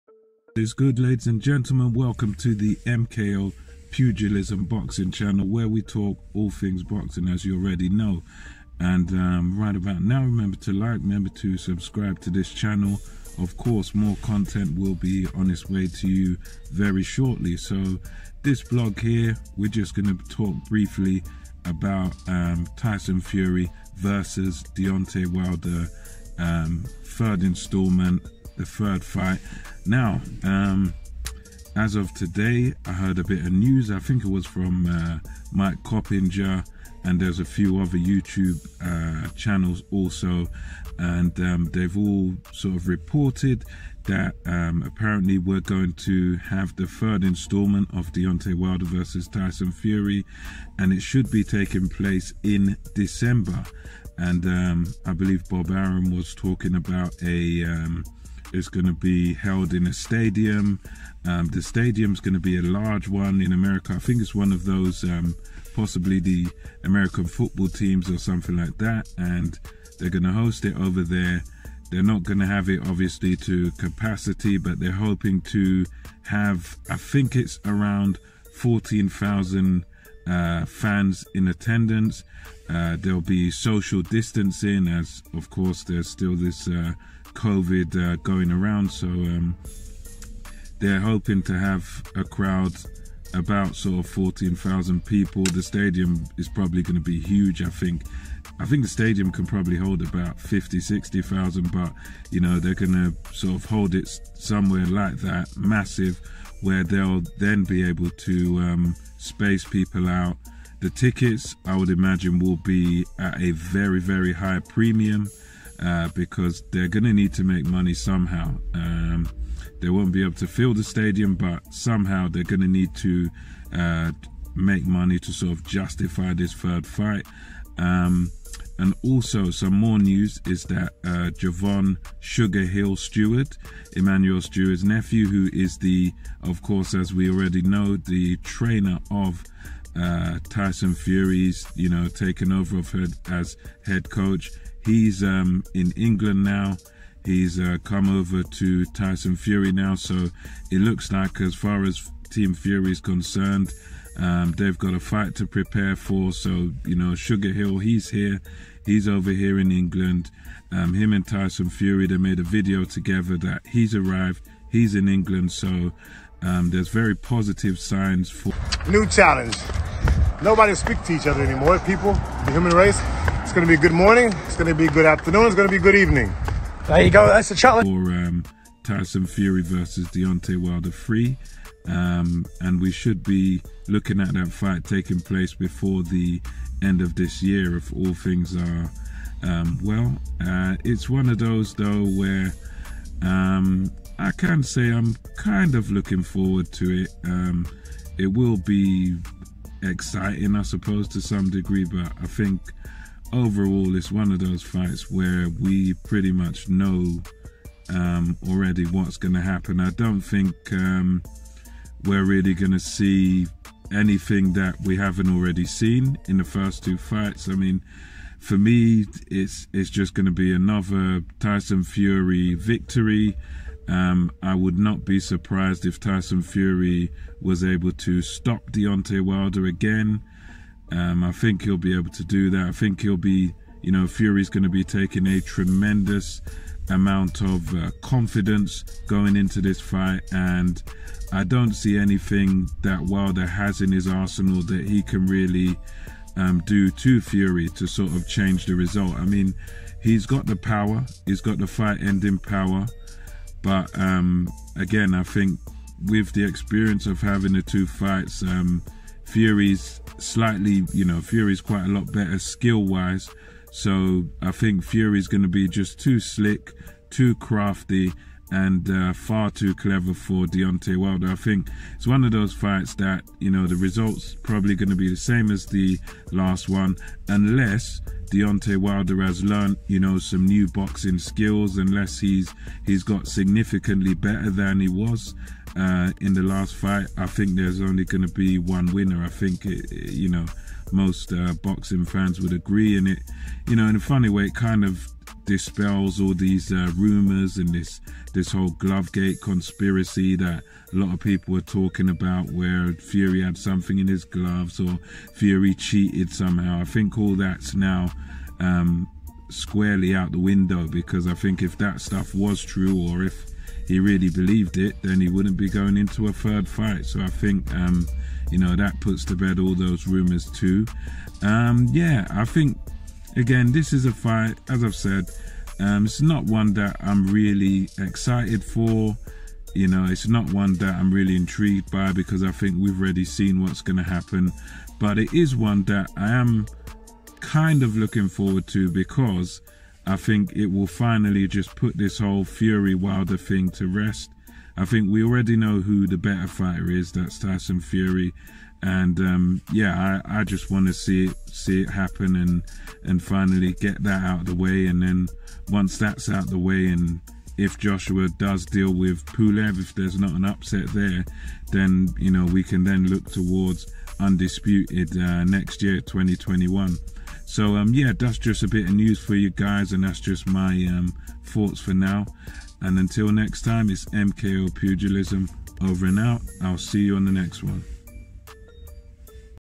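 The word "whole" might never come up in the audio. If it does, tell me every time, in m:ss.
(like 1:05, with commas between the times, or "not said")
4:58, 5:42.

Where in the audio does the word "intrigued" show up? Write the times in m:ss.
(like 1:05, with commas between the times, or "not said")
5:31.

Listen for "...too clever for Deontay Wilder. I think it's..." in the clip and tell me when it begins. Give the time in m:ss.
4:29.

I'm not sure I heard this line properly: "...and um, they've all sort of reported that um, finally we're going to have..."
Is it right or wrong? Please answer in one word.
wrong.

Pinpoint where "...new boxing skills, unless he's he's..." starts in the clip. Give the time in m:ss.
4:40.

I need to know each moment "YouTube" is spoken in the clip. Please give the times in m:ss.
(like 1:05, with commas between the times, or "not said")
0:37.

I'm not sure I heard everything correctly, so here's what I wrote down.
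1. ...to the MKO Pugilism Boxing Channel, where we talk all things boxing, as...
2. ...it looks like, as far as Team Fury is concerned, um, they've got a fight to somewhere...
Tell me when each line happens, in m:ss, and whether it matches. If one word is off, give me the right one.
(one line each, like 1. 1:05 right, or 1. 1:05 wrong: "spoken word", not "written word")
1. 0:02 right
2. 2:30 wrong: "prepare", not "somewhere".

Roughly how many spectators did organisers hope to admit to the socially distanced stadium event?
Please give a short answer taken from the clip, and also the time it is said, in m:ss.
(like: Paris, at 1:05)
14,000, at 1:18.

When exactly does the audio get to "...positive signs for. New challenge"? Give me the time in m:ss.
2:47.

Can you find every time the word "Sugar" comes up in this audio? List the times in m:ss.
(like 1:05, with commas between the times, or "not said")
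2:12, 2:37.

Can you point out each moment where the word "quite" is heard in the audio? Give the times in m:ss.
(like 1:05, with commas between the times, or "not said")
4:21.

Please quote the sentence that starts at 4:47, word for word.
I think there's only going to be one winner.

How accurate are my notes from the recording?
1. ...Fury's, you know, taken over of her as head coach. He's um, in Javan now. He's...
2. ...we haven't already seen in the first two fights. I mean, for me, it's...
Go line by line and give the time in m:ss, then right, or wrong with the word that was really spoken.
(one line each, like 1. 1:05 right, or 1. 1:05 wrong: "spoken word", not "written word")
1. 2:20 wrong: "England", not "Javan"
2. 3:34 right.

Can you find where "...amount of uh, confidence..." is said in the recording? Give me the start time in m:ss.
3:56.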